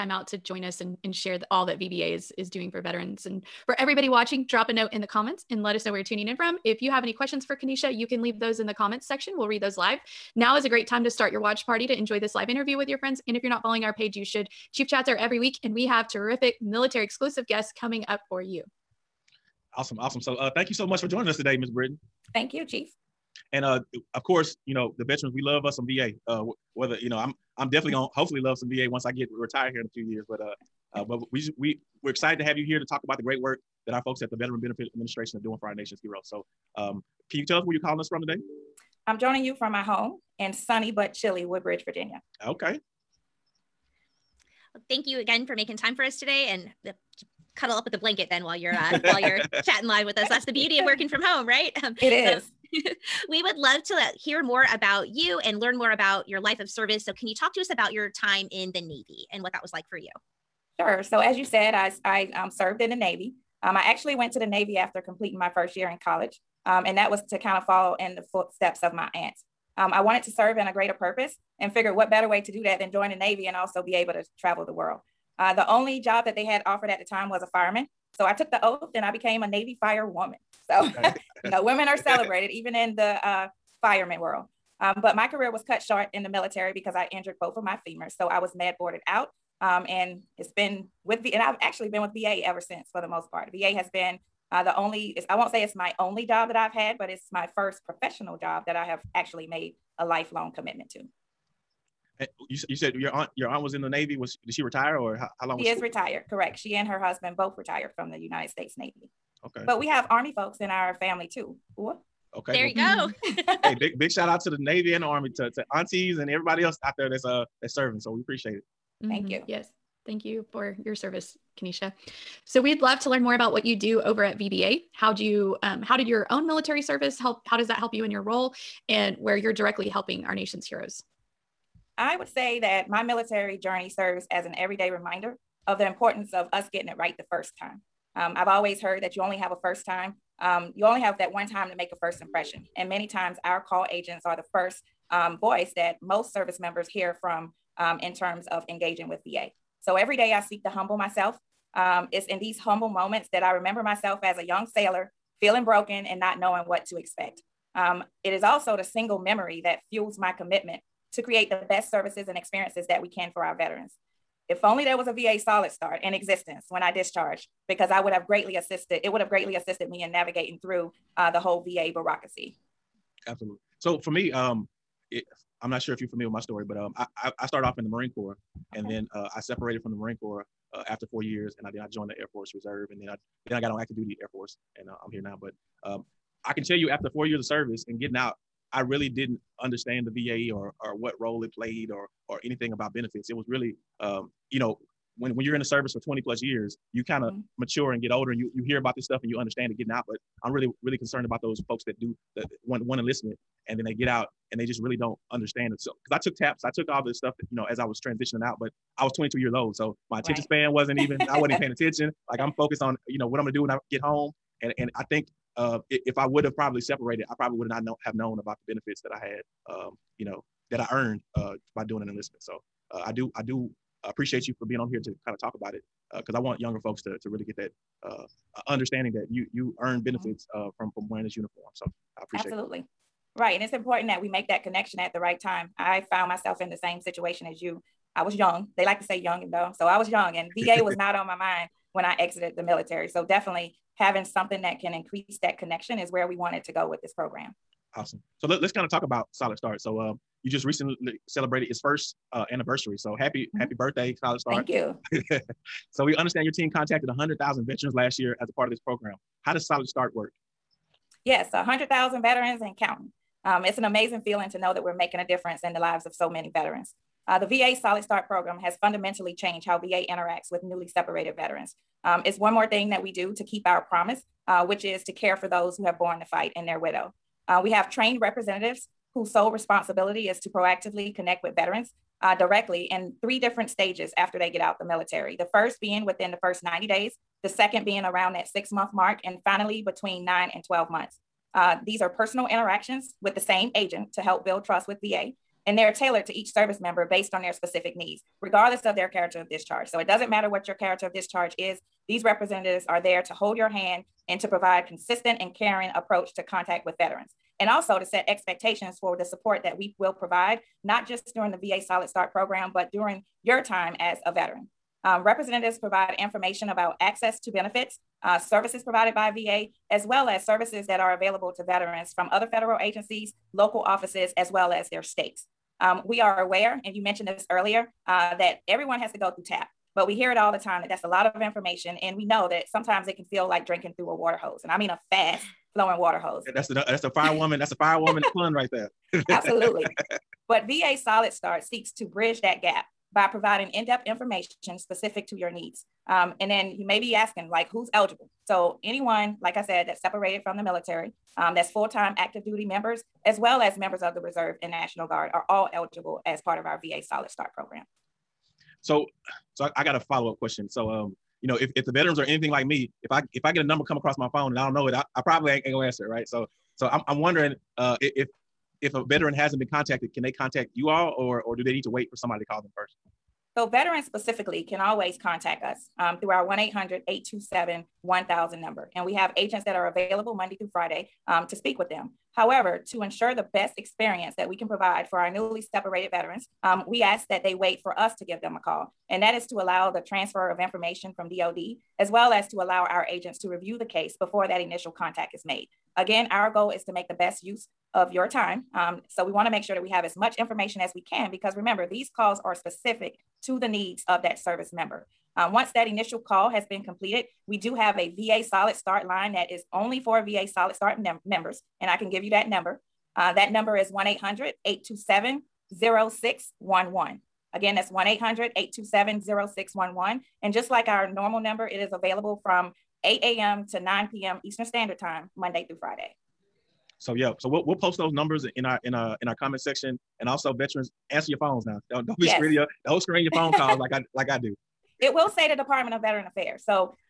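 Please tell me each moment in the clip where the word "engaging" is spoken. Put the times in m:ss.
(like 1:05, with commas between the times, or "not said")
2:28.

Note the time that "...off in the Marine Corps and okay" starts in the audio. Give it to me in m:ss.
2:57.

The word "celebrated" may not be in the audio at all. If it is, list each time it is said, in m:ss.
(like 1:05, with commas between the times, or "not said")
1:21, 4:11.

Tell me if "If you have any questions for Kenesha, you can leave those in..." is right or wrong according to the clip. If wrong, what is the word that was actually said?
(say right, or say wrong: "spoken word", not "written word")
right.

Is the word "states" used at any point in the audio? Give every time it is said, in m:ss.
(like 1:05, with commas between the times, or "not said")
1:48, 5:25.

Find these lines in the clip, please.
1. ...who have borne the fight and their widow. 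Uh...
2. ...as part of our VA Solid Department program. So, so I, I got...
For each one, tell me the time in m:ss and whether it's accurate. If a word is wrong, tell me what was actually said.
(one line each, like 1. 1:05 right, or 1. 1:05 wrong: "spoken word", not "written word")
1. 4:35 right
2. 5:56 wrong: "Start", not "Department".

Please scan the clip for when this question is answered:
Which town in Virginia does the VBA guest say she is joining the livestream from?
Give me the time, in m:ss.
0:41.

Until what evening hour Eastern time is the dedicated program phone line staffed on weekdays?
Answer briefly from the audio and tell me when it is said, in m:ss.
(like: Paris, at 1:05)
9 p.m., at 7:03.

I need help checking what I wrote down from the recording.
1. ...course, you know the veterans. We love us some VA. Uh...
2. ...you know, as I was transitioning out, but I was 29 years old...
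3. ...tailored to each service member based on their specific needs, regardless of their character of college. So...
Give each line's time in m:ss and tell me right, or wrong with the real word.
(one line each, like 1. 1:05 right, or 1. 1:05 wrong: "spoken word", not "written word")
1. 0:24 right
2. 3:27 wrong: "22", not "29"
3. 4:55 wrong: "discharge", not "college".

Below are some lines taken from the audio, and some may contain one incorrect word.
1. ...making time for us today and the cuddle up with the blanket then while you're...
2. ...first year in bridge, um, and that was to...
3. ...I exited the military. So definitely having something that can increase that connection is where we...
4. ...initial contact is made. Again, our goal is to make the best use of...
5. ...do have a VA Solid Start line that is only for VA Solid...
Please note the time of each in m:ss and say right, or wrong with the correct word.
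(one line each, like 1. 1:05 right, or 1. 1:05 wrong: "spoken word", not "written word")
1. 0:45 right
2. 1:05 wrong: "college", not "bridge"
3. 4:02 right
4. 6:34 right
5. 6:47 right.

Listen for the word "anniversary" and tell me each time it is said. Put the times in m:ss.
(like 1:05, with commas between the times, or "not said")
4:12.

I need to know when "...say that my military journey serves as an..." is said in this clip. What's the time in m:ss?
2:12.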